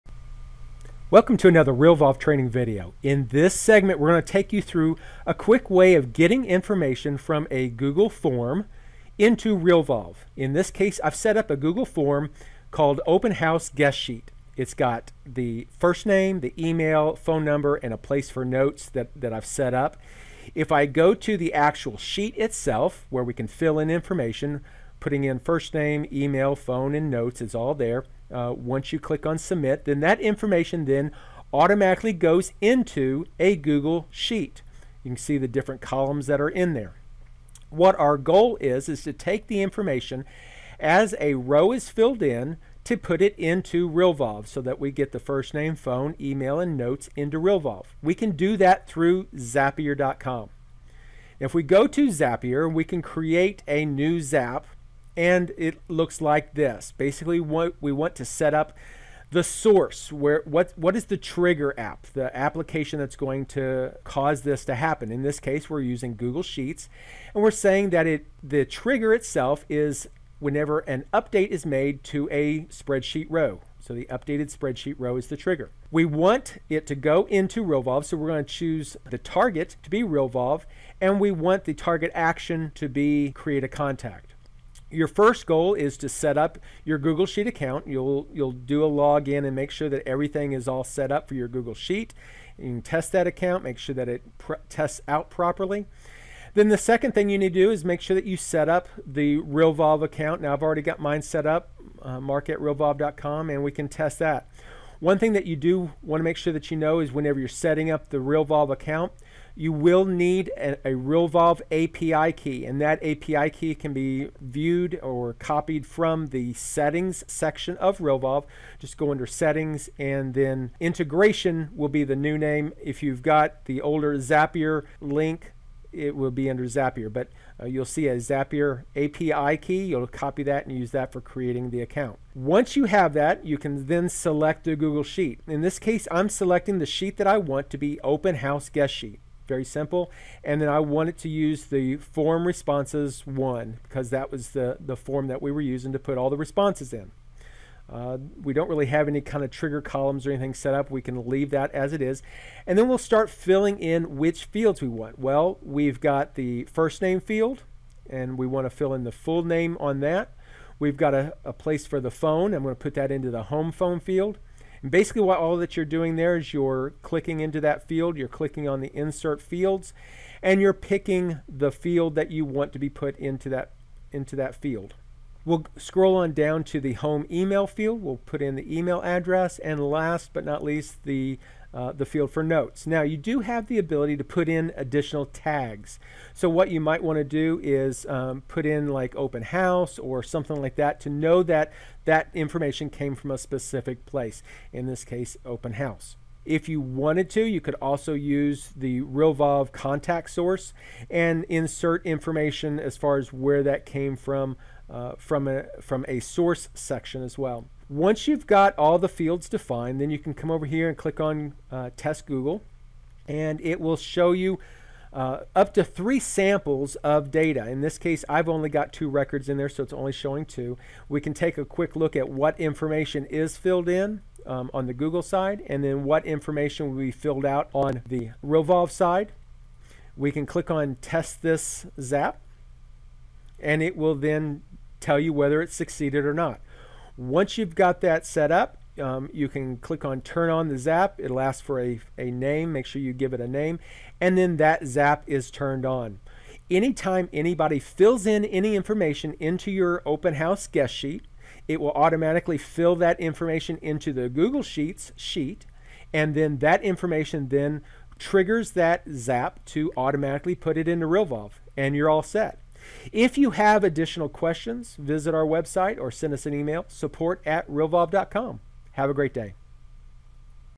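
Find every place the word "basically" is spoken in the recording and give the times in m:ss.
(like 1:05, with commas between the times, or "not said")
0:56, 2:44.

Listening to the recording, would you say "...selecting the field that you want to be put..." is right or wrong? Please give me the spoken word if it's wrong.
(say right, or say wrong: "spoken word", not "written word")
wrong: "picking", not "selecting".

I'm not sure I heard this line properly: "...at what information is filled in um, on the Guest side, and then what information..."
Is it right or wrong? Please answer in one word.
wrong.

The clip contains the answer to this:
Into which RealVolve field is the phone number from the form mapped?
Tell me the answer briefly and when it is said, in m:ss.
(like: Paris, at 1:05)
home phone, at 2:43.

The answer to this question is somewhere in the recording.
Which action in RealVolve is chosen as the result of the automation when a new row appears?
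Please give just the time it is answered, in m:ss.
1:23.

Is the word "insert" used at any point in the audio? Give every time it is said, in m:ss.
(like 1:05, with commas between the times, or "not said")
2:48, 3:21.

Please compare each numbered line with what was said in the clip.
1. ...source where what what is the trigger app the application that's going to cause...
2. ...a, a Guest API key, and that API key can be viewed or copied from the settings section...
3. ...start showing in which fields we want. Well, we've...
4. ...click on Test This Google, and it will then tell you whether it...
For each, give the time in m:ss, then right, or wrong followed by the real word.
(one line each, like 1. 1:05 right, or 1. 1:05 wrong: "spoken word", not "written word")
1. 0:59 right
2. 1:50 wrong: "RealVolve", not "Guest"
3. 2:32 wrong: "filling", not "showing"
4. 3:50 wrong: "Zap", not "Google".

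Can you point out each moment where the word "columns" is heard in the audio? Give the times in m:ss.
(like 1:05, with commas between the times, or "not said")
0:35, 2:29.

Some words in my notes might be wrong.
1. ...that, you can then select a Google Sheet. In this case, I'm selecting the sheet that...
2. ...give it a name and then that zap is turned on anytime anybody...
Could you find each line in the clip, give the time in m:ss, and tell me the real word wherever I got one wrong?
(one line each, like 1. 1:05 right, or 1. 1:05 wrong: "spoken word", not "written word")
1. 2:13 right
2. 4:03 right.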